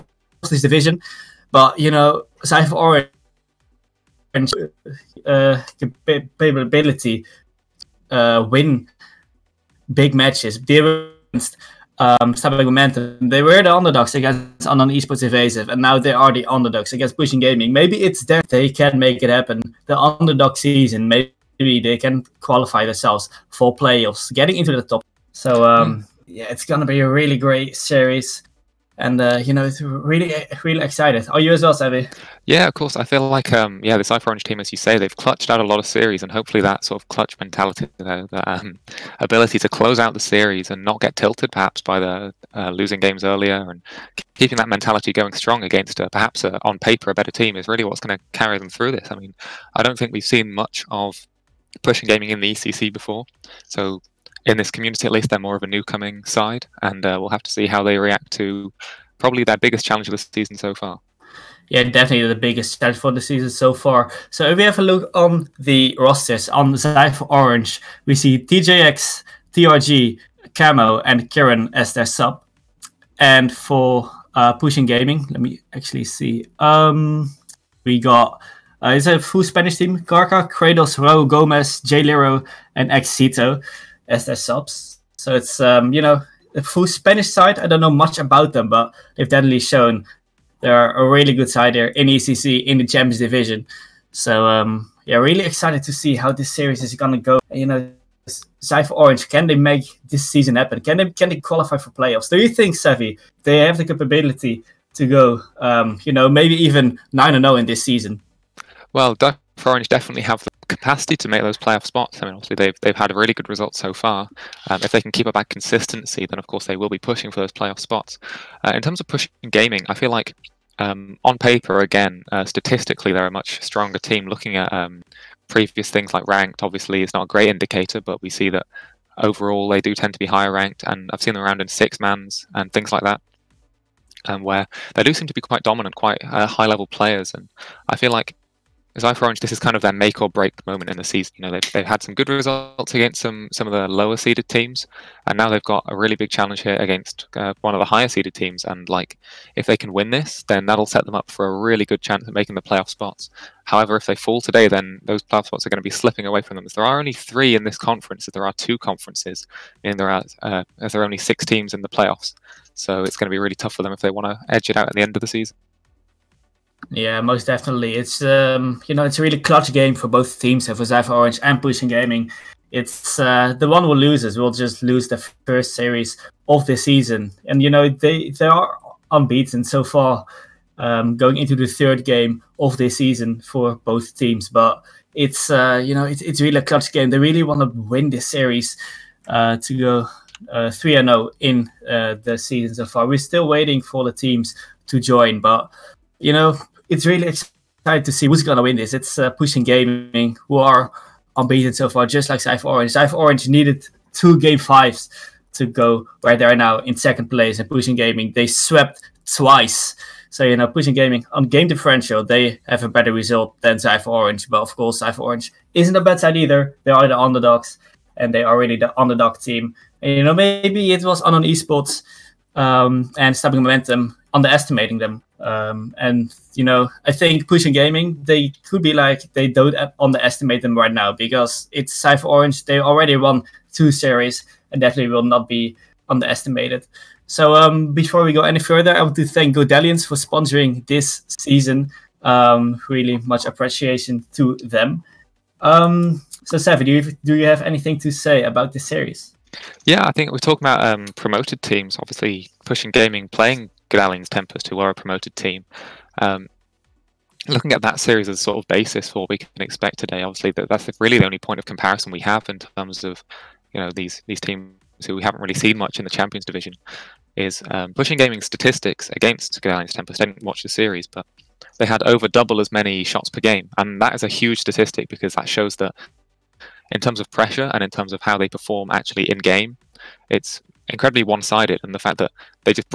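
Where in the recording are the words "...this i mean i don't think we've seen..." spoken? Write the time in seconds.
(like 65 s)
48 s.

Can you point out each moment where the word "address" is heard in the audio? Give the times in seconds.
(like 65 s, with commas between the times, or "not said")
not said.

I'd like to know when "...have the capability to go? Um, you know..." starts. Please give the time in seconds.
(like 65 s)
103 s.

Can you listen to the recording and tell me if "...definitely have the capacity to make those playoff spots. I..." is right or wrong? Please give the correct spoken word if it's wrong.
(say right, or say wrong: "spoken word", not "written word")
right.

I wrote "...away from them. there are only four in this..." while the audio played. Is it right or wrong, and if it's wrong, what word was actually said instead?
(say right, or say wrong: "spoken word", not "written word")
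wrong: "three", not "four".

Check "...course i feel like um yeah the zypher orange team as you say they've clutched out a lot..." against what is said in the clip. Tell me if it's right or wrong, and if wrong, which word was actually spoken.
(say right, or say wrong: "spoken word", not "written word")
right.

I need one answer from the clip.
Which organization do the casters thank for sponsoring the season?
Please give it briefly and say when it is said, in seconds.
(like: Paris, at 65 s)
Godalions, at 239 s.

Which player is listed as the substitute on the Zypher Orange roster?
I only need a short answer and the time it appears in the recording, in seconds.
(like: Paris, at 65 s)
Kieran, at 71 s.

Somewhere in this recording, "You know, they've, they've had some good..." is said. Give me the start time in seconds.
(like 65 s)
141 s.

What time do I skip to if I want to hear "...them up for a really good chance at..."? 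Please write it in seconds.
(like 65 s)
151 s.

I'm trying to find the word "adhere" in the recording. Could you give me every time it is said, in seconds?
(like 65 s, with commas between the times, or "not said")
not said.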